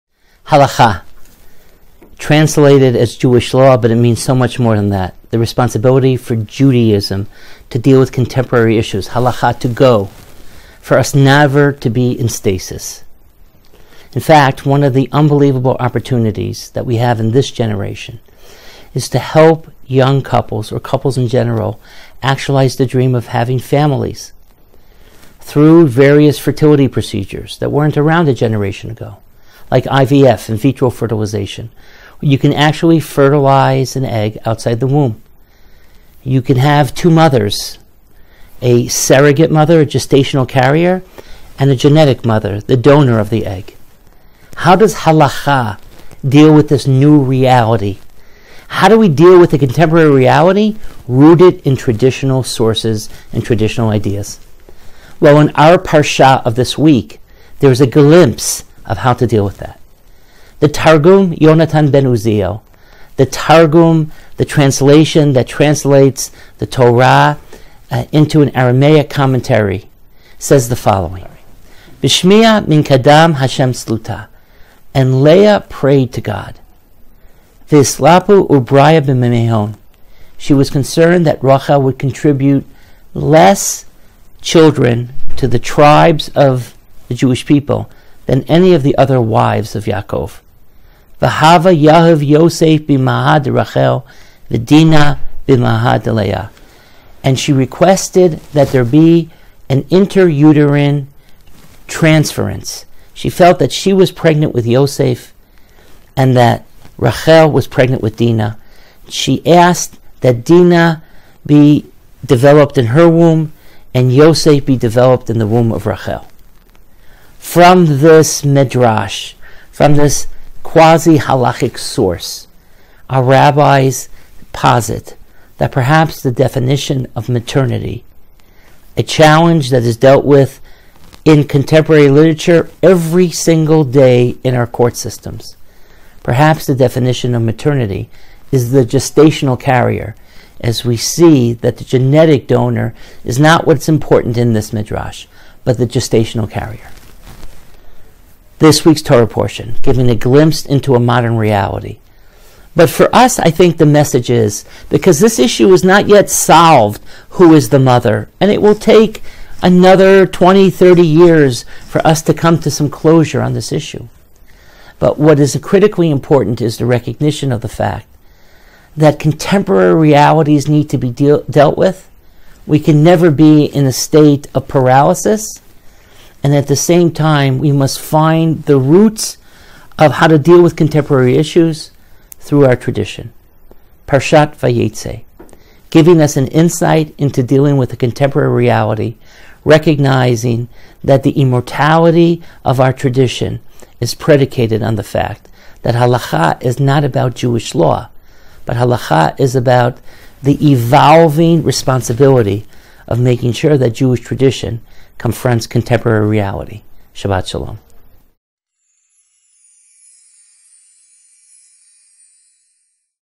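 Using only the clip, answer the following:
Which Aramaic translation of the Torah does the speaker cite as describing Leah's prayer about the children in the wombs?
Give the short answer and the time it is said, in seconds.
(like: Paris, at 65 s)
Yonatan ben Uziel, at 61 s.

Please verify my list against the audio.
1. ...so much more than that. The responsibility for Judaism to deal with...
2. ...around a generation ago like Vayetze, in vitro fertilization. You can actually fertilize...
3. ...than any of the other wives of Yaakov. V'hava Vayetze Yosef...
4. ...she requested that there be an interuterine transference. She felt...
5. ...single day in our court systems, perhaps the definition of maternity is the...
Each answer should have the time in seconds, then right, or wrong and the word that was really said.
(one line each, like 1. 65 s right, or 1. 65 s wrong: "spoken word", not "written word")
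1. 4 s right
2. 27 s wrong: "IVF", not "Vayetze"
3. 88 s wrong: "Yahav", not "Vayetze"
4. 97 s right
5. 133 s right.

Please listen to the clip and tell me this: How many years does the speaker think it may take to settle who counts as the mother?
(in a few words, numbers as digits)
20, 30.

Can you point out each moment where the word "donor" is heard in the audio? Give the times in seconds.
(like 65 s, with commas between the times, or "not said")
42 s, 142 s.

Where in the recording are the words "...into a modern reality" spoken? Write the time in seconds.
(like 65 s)
150 s.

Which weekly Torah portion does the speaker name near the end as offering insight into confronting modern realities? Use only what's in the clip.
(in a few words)
Parshat Vayetze.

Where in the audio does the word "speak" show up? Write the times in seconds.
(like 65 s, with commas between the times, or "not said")
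not said.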